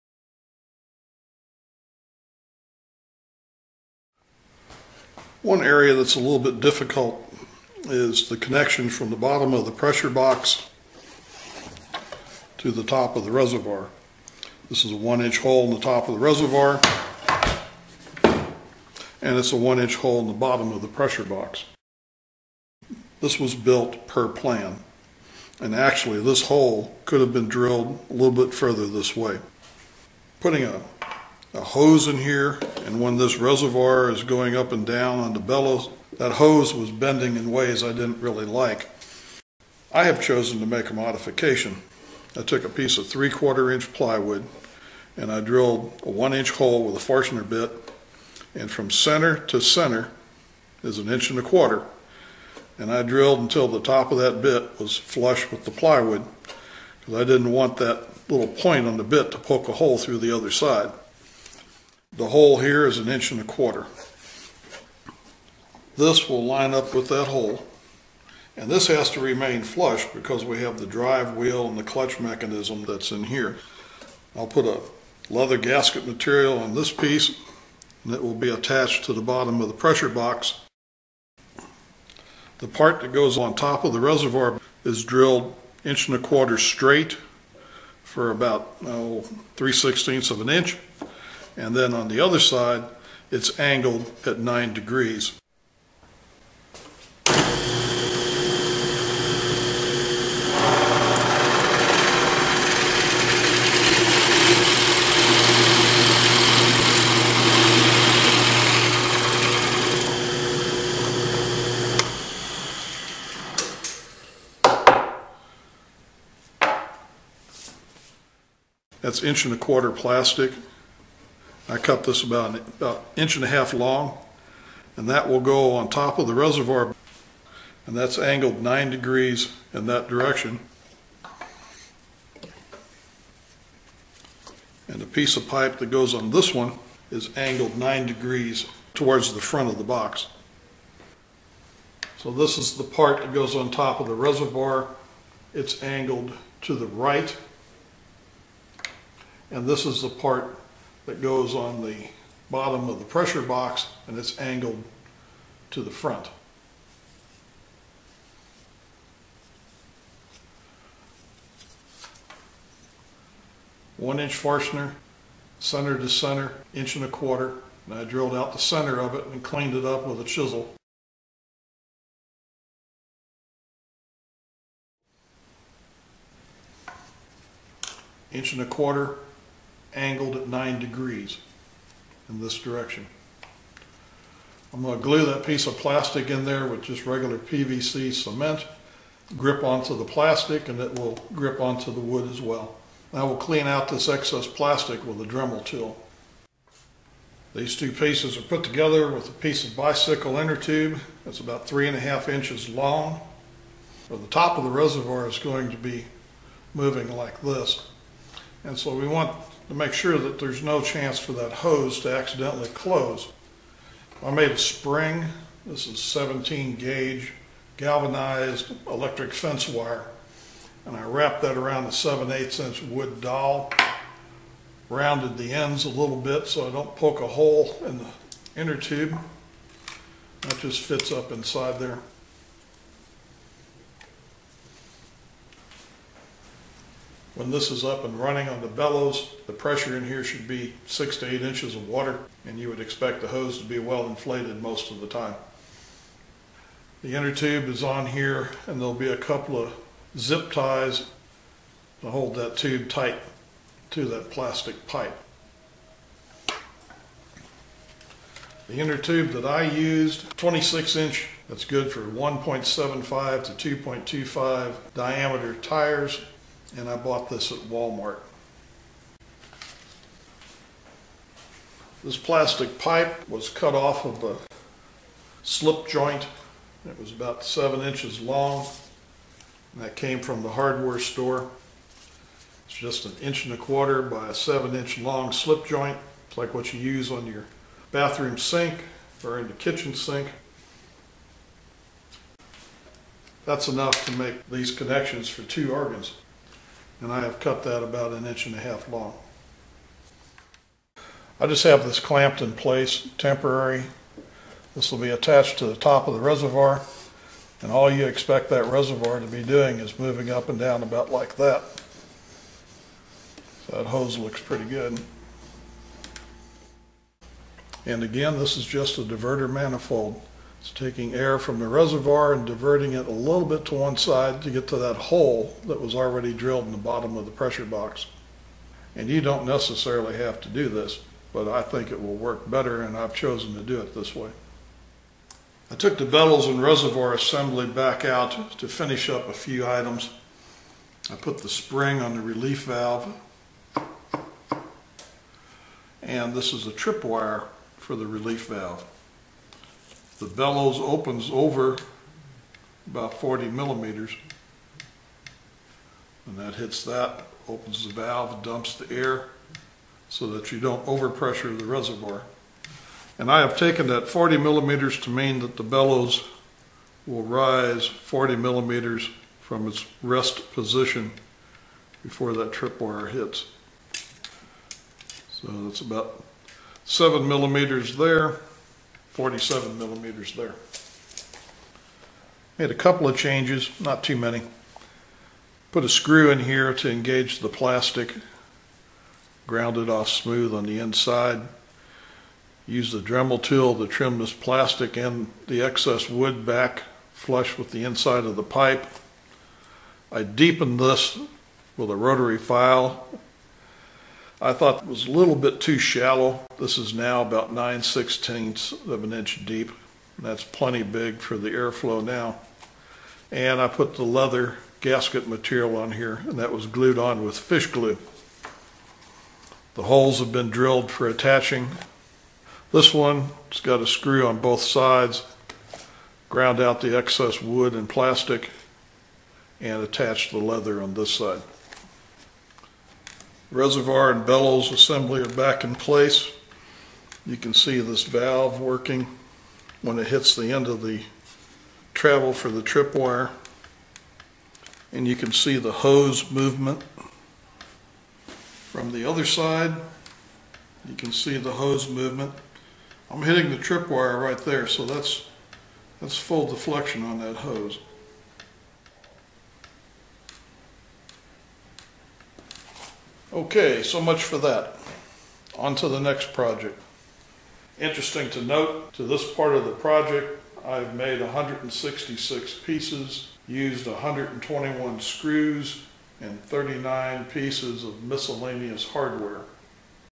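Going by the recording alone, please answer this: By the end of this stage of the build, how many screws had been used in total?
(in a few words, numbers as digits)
121.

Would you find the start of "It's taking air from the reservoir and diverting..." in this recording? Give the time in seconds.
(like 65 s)
320 s.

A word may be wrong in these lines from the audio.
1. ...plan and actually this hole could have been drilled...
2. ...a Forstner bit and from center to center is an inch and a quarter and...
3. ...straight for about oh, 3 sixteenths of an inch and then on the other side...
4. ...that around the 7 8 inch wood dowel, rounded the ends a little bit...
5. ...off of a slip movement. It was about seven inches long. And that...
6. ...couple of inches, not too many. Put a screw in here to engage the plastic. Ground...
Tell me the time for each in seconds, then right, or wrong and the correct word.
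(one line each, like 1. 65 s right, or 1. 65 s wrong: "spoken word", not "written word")
1. 24 s right
2. 46 s right
3. 86 s right
4. 221 s right
5. 273 s wrong: "joint", not "movement"
6. 382 s wrong: "changes", not "inches".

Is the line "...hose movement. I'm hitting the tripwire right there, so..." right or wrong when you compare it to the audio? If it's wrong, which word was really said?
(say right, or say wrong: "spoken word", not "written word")
right.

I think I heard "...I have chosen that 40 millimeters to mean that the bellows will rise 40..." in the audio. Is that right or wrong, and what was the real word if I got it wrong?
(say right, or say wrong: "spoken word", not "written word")
wrong: "taken", not "chosen".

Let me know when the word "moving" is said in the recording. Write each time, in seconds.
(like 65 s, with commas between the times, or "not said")
206 s, 309 s.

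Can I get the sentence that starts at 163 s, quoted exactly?
One inch Forstner, center to center, inch and a quarter.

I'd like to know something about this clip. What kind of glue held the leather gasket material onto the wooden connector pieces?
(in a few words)
fish glue.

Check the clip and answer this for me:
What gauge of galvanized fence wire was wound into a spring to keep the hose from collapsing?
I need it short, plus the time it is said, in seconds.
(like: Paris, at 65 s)
17 gauge, at 216 s.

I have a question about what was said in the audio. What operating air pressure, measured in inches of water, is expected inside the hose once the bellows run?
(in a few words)
6 to 8 inches.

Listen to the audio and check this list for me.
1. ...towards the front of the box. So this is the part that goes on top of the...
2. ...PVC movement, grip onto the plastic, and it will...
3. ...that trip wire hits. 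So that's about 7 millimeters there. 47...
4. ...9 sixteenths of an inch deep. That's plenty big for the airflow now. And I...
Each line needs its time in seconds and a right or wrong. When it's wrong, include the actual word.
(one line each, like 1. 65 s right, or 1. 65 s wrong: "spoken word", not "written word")
1. 138 s right
2. 187 s wrong: "cement", not "movement"
3. 372 s right
4. 407 s right.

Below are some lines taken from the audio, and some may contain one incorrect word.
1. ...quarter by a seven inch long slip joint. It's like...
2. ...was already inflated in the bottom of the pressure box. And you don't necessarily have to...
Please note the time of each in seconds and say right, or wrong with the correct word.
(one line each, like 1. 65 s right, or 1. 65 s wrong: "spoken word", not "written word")
1. 283 s right
2. 325 s wrong: "drilled", not "inflated".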